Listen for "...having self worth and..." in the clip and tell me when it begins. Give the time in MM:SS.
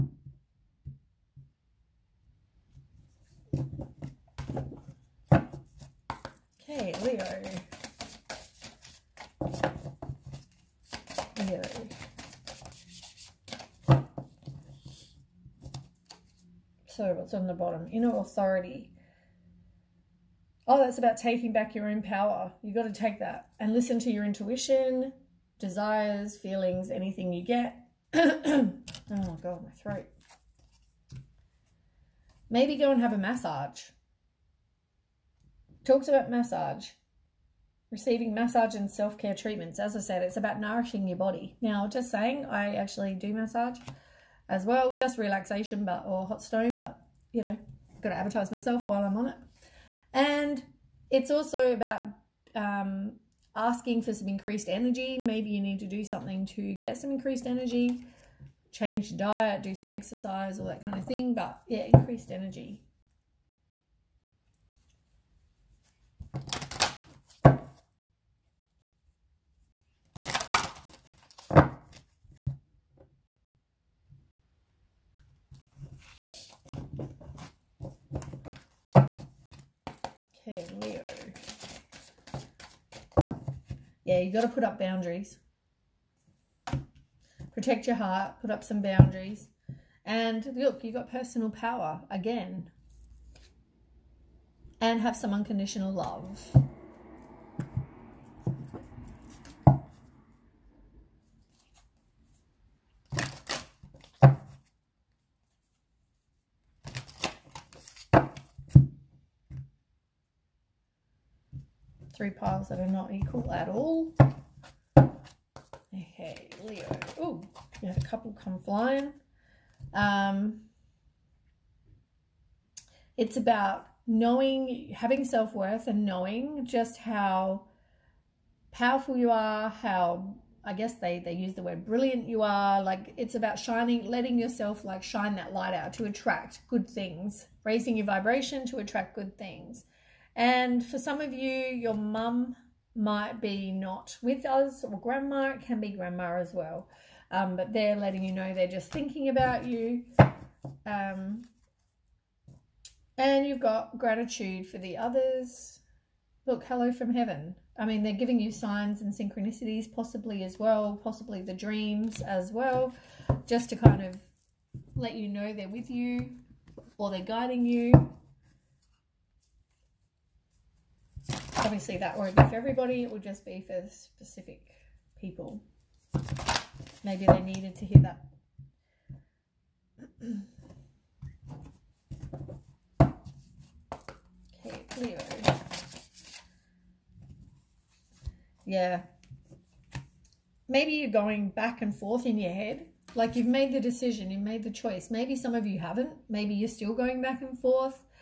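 02:04.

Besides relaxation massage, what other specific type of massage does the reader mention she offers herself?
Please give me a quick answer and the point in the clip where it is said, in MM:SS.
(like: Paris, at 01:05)
Hot stone, at 00:46.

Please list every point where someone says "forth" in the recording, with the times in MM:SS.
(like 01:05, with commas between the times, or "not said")
03:11, 03:17.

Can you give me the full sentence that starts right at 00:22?
You've got to take that and listen to your intuition, desires, feelings, anything you get.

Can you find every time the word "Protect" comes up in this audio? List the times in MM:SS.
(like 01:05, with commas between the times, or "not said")
01:27.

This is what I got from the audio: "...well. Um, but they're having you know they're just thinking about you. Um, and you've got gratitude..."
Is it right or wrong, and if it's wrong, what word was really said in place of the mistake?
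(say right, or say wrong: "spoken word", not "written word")
wrong: "letting", not "having".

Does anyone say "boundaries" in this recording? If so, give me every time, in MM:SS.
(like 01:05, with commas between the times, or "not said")
01:24, 01:28.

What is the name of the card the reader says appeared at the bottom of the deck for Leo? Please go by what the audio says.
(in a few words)
Inner authority.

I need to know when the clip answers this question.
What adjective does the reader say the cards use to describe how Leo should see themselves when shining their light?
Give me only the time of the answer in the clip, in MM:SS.
02:11.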